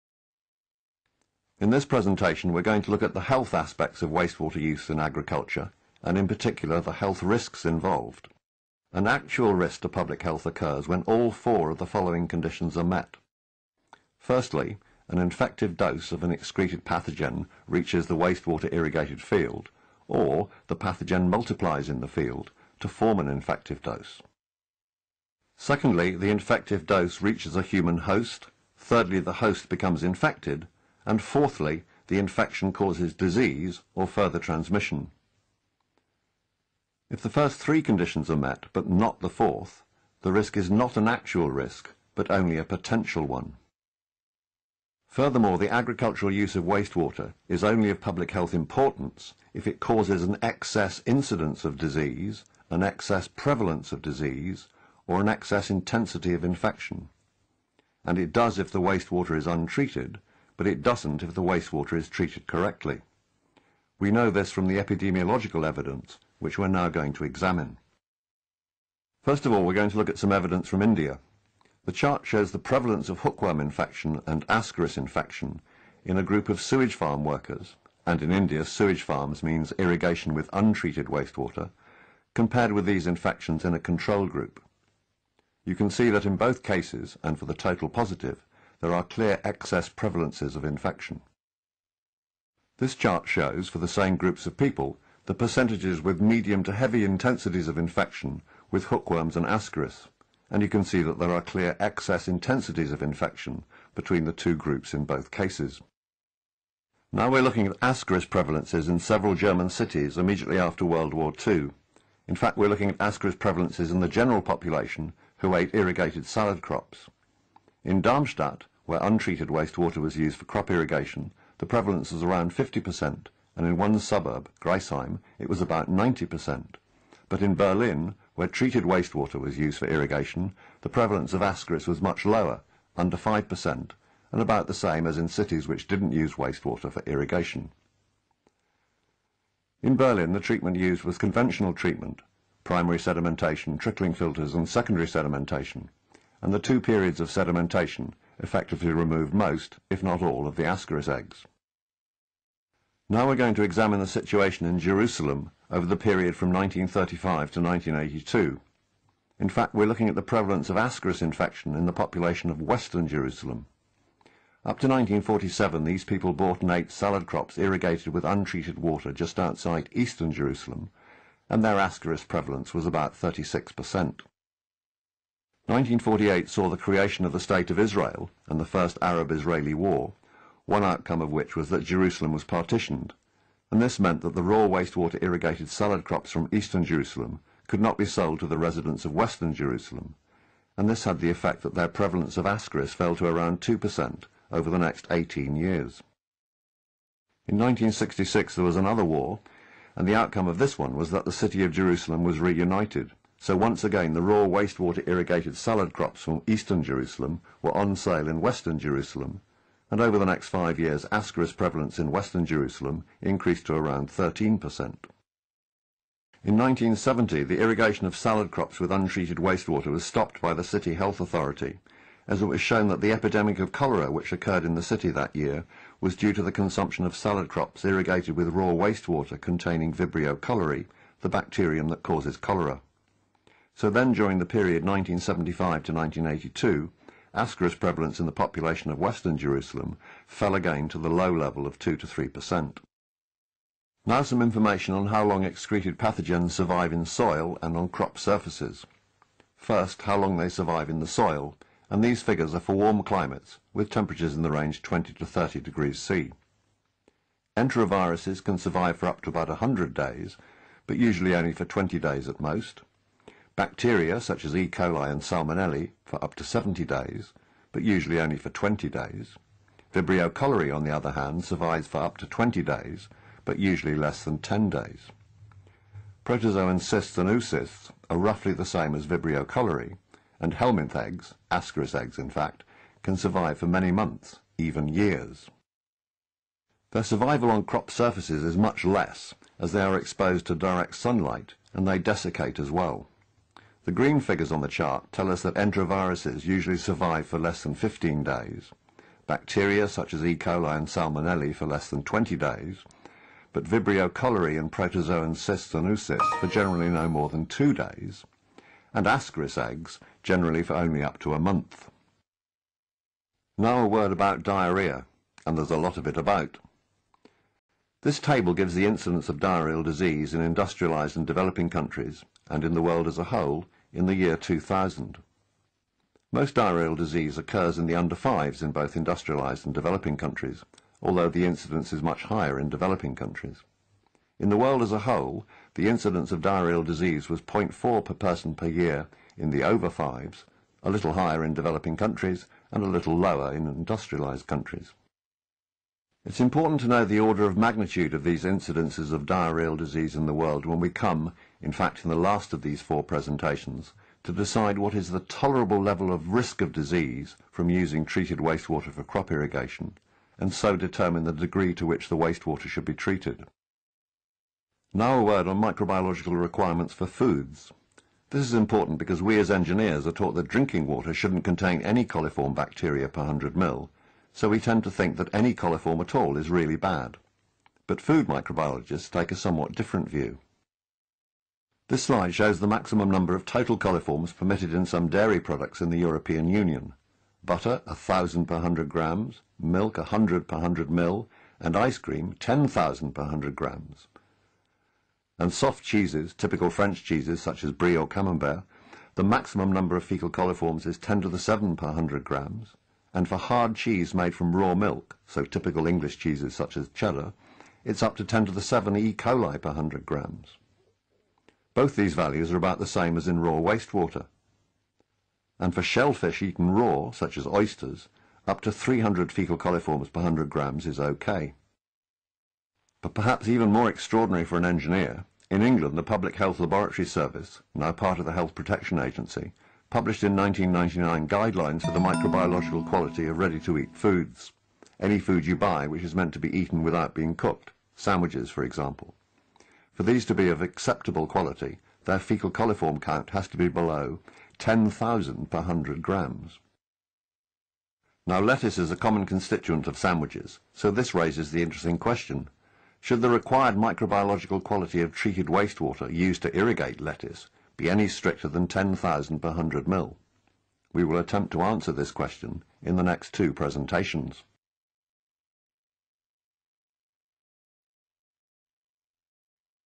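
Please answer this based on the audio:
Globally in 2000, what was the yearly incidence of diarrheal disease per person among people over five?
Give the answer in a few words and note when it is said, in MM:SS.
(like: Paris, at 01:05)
0.4, at 05:37.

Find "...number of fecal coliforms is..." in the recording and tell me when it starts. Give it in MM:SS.
06:39.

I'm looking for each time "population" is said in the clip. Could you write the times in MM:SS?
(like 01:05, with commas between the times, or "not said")
01:54, 02:41, 03:58.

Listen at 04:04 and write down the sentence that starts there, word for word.
Now some information on how long excreted pathogens survive in soil and on crop surfaces.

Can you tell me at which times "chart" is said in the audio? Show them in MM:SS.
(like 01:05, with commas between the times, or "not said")
01:11, 01:32, 04:54.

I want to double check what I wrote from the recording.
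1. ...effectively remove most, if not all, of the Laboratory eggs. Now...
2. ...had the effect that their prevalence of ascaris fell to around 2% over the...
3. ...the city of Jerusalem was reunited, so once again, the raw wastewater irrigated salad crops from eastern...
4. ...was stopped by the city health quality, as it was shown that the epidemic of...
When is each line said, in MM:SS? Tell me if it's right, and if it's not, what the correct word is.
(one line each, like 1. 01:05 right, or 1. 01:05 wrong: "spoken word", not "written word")
1. 02:28 wrong: "Ascaris", not "Laboratory"
2. 03:11 right
3. 03:21 right
4. 03:39 wrong: "authority", not "quality".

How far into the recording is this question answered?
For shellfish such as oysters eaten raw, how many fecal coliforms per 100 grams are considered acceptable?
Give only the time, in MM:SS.
06:58.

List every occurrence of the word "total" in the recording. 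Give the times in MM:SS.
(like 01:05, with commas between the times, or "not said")
01:27, 06:23.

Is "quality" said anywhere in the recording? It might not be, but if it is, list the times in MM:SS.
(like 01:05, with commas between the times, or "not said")
07:12, 07:21, 07:34.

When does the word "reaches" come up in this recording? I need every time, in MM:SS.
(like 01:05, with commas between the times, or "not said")
00:17, 00:27.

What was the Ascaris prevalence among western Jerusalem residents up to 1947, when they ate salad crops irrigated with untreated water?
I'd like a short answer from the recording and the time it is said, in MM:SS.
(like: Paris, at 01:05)
36%, at 02:53.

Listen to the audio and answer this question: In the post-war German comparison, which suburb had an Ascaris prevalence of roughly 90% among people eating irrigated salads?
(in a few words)
Griesheim.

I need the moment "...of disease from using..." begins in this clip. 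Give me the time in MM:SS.
05:56.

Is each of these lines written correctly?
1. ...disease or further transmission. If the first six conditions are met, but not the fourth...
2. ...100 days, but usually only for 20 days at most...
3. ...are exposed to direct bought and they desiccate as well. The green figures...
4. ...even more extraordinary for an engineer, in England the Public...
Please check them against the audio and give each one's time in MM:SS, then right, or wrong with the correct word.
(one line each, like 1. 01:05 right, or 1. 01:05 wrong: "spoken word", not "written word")
1. 00:33 wrong: "three", not "six"
2. 04:19 right
3. 04:49 wrong: "sunlight", not "bought"
4. 07:03 right.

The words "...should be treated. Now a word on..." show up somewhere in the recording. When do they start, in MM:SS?
06:02.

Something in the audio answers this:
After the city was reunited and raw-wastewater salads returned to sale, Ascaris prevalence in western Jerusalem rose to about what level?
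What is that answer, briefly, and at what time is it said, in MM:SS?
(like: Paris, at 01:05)
13%, at 03:34.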